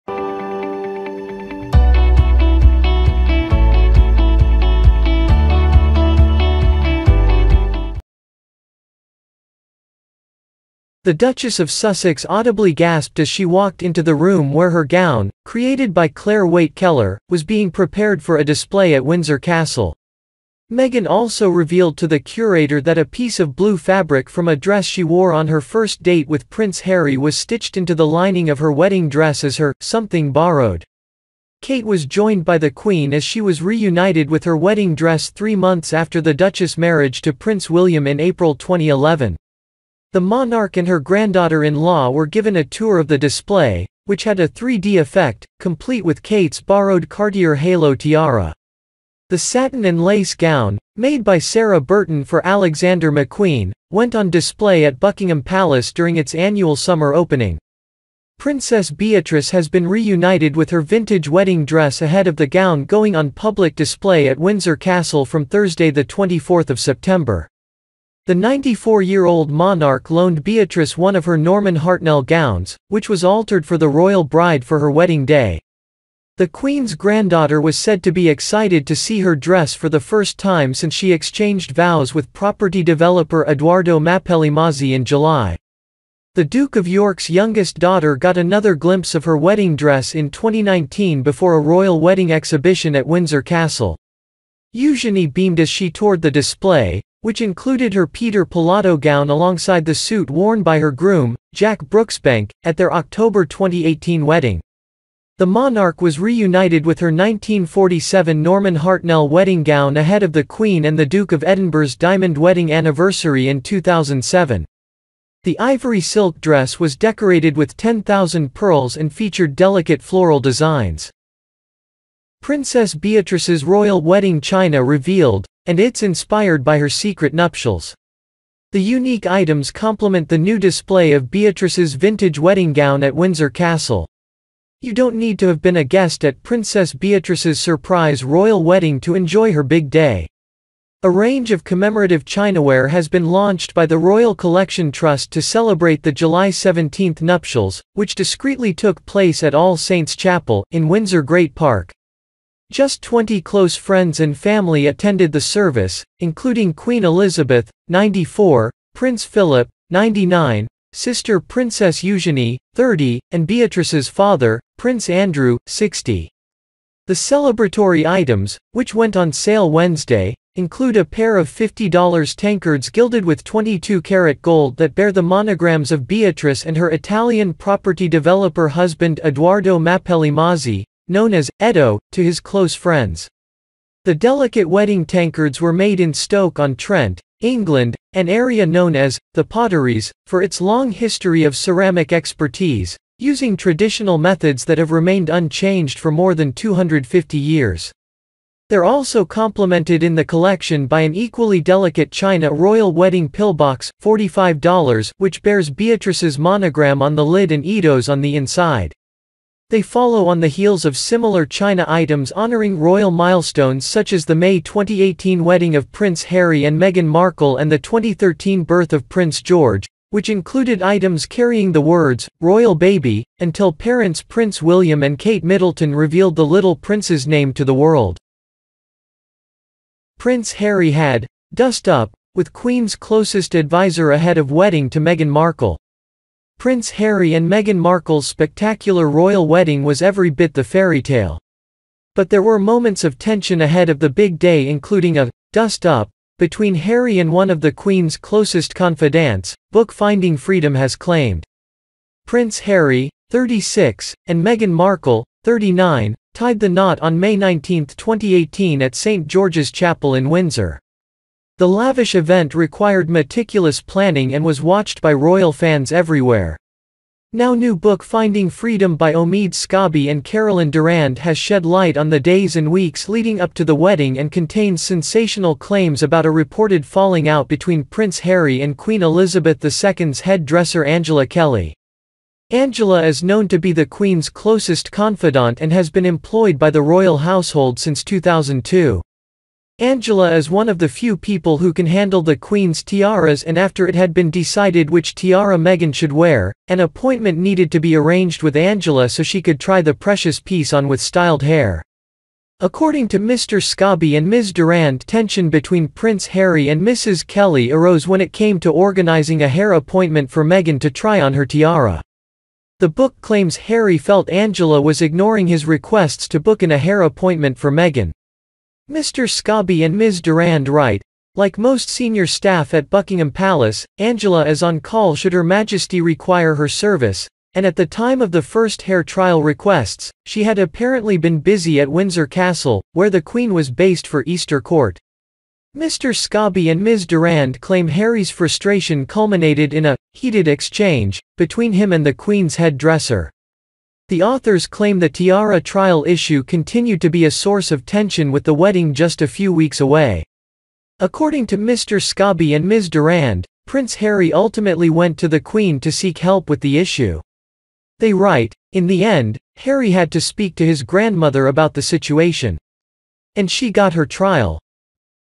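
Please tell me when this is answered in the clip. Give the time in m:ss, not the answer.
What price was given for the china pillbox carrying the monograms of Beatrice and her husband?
3:24.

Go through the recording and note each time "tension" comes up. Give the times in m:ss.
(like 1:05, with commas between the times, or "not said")
4:03, 5:05, 5:47.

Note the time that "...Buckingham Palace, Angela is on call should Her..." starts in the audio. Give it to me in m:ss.
5:22.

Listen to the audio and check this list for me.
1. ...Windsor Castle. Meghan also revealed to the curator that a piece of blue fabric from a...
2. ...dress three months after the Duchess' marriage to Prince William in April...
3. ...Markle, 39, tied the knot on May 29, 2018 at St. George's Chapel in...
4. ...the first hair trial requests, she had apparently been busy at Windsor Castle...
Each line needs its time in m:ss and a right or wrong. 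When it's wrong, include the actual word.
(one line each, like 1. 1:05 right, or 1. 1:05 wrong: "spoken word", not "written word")
1. 0:19 right
2. 0:34 right
3. 4:14 wrong: "19", not "29"
4. 5:28 right.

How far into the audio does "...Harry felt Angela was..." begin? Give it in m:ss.
5:13.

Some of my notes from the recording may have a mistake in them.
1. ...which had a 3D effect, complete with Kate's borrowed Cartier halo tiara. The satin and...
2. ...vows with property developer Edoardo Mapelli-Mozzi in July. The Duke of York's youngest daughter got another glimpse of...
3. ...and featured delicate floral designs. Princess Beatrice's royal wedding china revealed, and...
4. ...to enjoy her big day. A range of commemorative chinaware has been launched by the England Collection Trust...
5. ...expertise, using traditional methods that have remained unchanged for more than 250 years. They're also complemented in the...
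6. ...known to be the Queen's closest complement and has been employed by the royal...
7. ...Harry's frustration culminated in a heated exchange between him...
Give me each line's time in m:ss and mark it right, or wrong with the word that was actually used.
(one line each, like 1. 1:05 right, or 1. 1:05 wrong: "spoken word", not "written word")
1. 0:44 right
2. 1:21 right
3. 1:58 right
4. 2:19 wrong: "Royal", not "England"
5. 3:12 right
6. 4:43 wrong: "confidant", not "complement"
7. 5:37 right.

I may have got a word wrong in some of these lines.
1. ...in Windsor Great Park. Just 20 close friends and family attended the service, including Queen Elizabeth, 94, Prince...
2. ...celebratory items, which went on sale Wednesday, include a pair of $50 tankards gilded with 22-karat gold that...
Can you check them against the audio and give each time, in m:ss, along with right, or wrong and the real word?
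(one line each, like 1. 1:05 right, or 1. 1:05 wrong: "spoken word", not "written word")
1. 2:30 right
2. 2:47 right.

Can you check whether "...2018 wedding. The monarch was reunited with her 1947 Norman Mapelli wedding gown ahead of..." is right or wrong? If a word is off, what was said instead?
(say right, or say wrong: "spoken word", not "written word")
wrong: "Hartnell", not "Mapelli".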